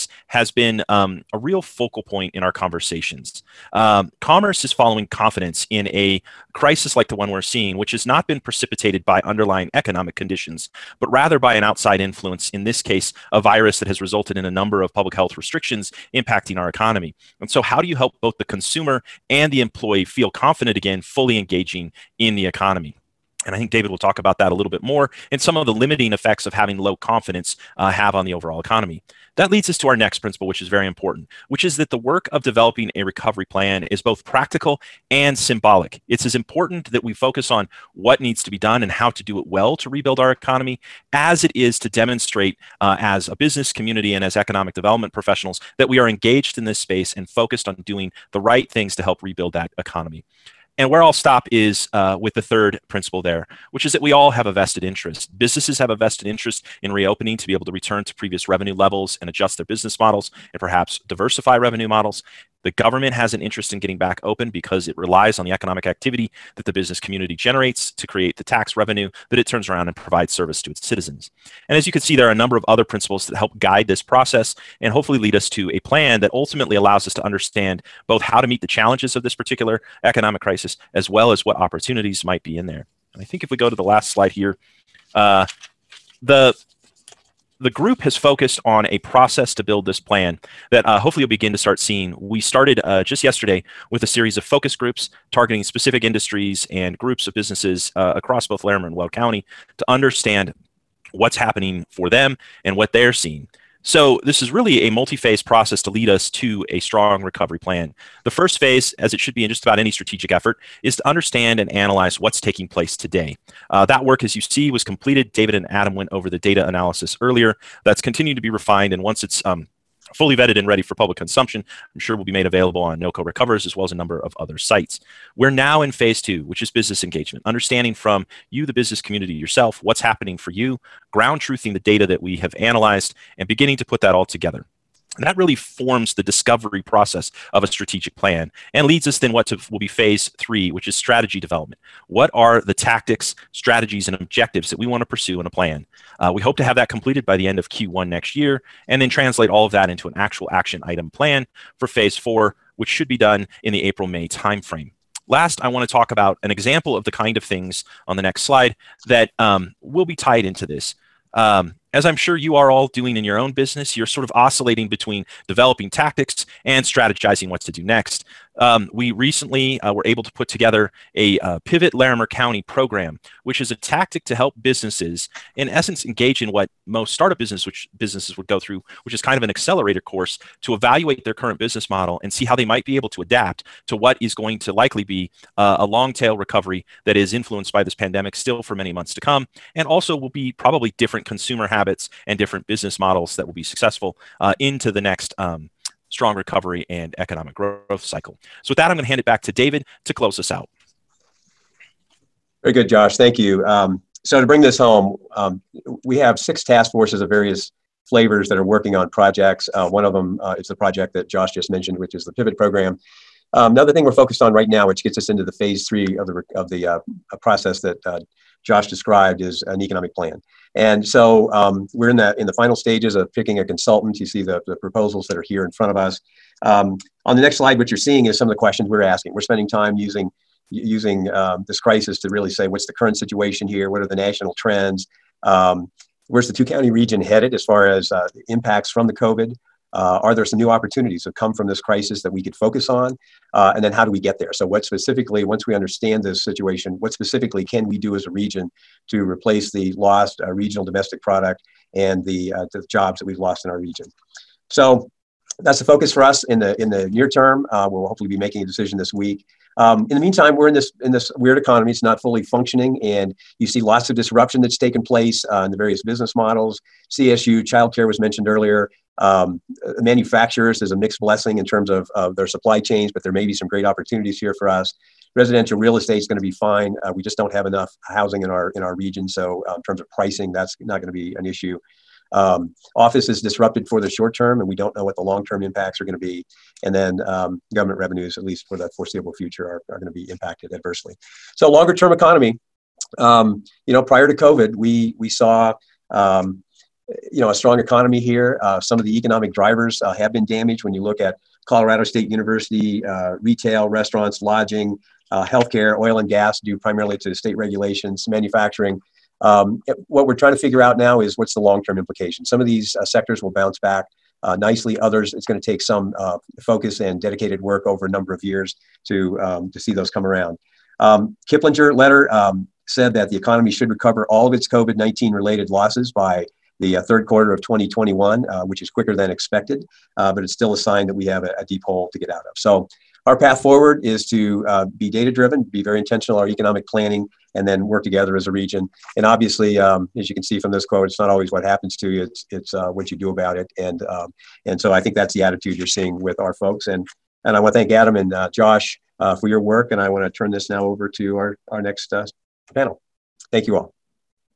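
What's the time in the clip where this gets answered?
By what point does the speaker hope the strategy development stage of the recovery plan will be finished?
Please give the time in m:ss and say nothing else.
2:27.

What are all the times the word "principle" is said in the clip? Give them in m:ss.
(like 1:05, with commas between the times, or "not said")
0:30, 0:52, 1:12.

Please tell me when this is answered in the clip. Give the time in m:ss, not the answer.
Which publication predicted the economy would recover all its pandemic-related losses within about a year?
5:21.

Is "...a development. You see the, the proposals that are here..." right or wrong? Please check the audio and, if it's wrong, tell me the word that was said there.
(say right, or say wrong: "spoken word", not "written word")
wrong: "consultant", not "development".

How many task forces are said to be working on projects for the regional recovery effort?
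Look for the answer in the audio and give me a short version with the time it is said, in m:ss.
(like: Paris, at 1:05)
6, at 3:26.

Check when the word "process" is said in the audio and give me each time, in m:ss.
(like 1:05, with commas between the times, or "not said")
1:14, 1:28, 1:45, 2:16, 3:37.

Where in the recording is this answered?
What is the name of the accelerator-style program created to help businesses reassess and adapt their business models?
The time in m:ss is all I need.
2:51.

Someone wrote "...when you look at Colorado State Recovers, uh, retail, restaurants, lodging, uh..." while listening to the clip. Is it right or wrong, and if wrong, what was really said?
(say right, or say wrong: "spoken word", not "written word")
wrong: "University", not "Recovers".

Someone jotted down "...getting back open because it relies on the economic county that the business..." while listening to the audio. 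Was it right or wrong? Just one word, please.
wrong.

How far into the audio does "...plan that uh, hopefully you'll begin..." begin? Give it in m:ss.
1:29.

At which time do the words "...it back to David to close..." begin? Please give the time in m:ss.
3:19.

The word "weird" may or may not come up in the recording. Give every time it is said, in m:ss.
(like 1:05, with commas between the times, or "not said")
4:21.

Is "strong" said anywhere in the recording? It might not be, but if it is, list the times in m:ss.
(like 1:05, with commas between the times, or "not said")
1:46, 3:16, 4:57.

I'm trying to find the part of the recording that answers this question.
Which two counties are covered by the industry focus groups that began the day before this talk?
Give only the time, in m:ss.
1:38.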